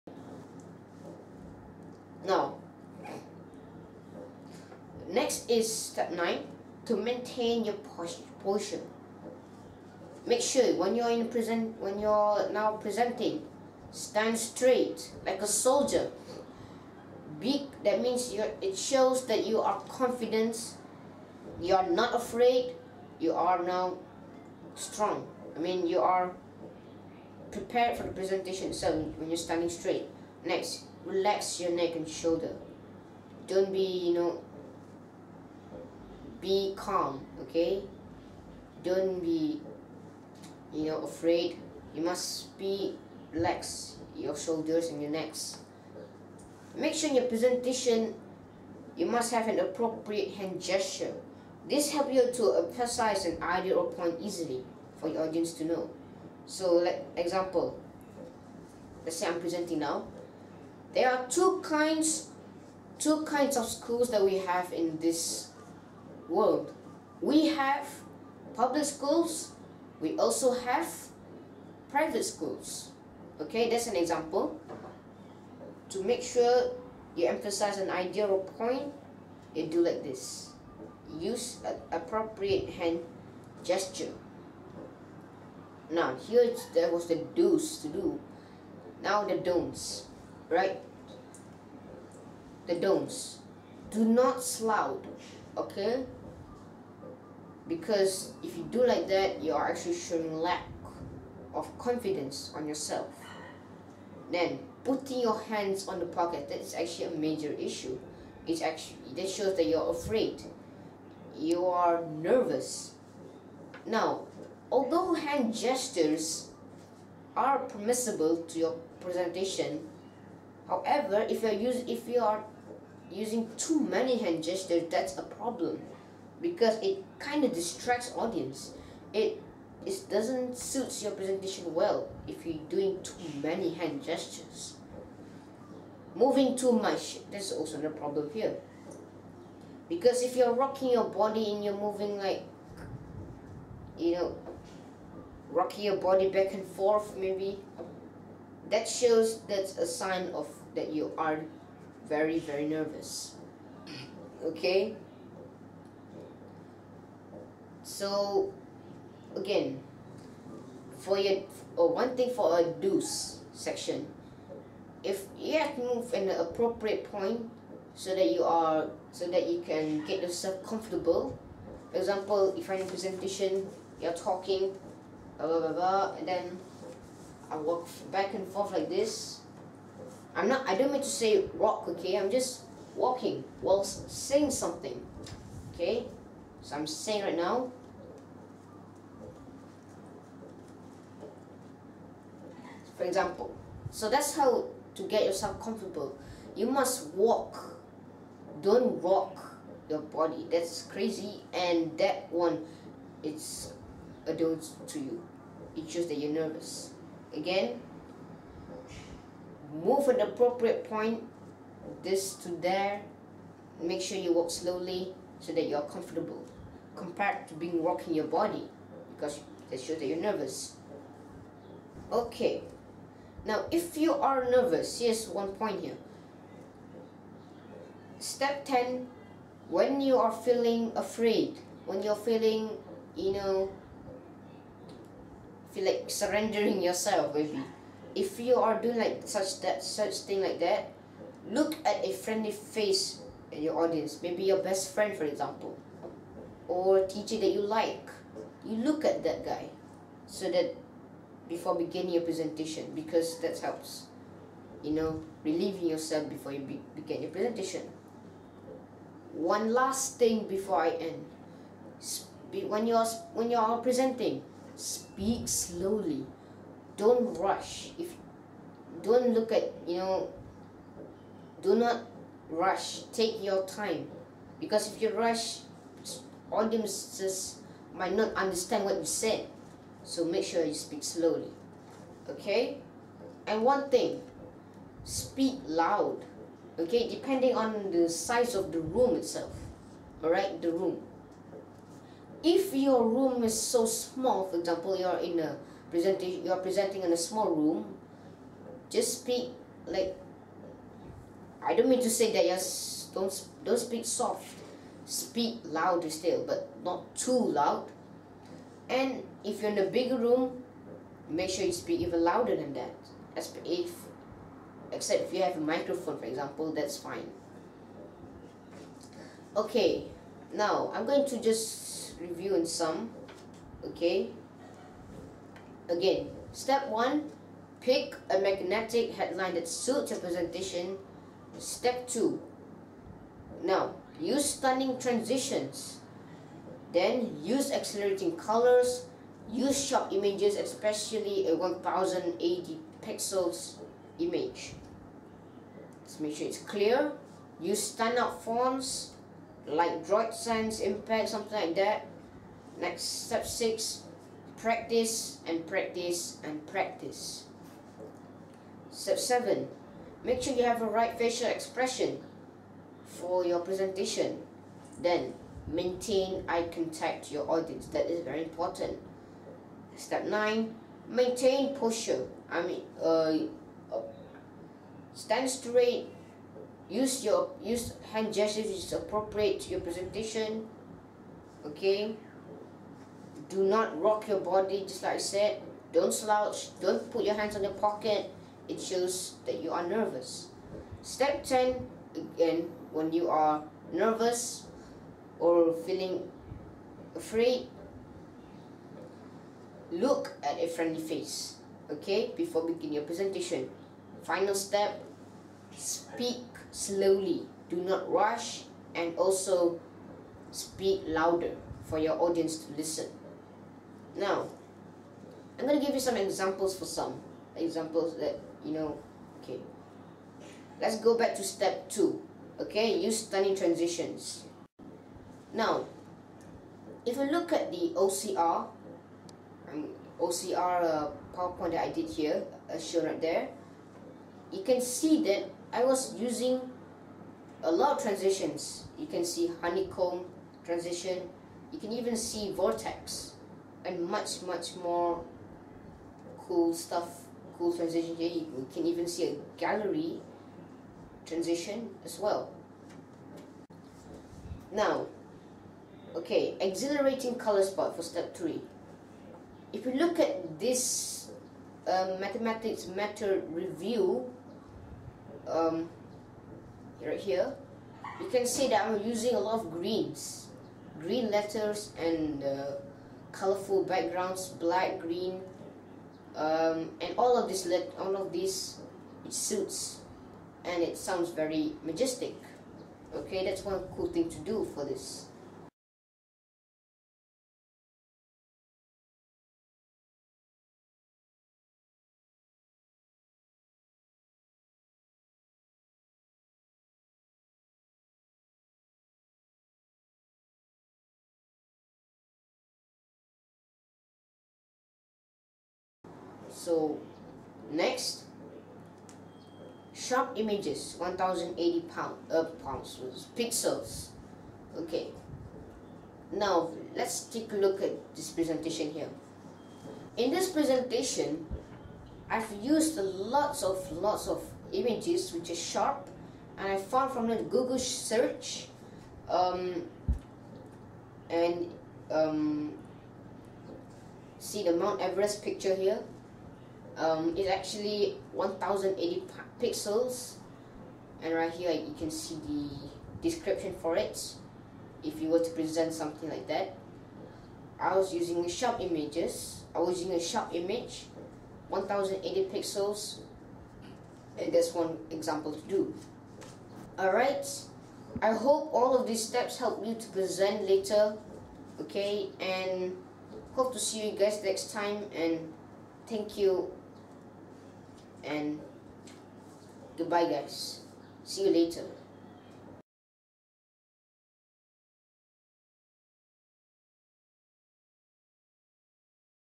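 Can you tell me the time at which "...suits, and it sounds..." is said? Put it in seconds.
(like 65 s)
479 s.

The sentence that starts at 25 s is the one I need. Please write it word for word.
I mean you are prepared for the presentation so when you're standing straight.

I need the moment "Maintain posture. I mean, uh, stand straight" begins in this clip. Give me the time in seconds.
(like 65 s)
371 s.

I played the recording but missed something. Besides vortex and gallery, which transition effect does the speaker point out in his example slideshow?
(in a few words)
honeycomb.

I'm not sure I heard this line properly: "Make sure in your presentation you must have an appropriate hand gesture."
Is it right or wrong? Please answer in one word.
right.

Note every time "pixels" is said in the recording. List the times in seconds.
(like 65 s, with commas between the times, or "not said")
343 s, 513 s, 539 s, 552 s.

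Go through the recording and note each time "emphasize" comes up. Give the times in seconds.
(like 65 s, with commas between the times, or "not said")
52 s, 77 s.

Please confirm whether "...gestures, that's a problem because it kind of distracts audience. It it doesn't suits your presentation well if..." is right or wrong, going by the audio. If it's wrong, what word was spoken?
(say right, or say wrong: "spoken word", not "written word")
right.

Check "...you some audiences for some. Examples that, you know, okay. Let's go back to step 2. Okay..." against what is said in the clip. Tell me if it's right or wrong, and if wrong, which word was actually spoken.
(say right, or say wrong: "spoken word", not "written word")
wrong: "examples", not "audiences".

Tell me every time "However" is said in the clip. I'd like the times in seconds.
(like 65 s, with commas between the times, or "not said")
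120 s.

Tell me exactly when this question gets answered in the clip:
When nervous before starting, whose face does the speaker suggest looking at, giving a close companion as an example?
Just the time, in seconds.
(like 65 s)
244 s.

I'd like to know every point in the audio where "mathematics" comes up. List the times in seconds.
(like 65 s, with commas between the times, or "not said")
462 s.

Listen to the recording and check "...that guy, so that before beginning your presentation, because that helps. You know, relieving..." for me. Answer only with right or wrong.
right.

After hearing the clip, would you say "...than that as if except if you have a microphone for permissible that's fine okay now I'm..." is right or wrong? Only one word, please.
wrong.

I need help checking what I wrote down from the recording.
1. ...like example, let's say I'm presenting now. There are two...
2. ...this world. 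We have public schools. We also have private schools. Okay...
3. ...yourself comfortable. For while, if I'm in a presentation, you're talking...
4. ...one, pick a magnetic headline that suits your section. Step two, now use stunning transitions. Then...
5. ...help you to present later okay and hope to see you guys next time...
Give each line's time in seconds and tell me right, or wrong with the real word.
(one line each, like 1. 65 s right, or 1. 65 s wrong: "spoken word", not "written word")
1. 56 s right
2. 64 s right
3. 170 s wrong: "example", not "while"
4. 326 s wrong: "presentation", not "section"
5. 559 s right.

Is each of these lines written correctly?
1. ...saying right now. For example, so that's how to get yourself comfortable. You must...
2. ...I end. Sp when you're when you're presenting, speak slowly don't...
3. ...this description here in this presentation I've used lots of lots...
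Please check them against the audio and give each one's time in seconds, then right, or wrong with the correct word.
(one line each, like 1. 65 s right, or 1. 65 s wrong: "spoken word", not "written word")
1. 186 s right
2. 260 s right
3. 518 s wrong: "presentation", not "description".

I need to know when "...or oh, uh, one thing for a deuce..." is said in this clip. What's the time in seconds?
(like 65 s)
161 s.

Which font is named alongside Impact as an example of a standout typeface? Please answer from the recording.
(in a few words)
Droid Sans.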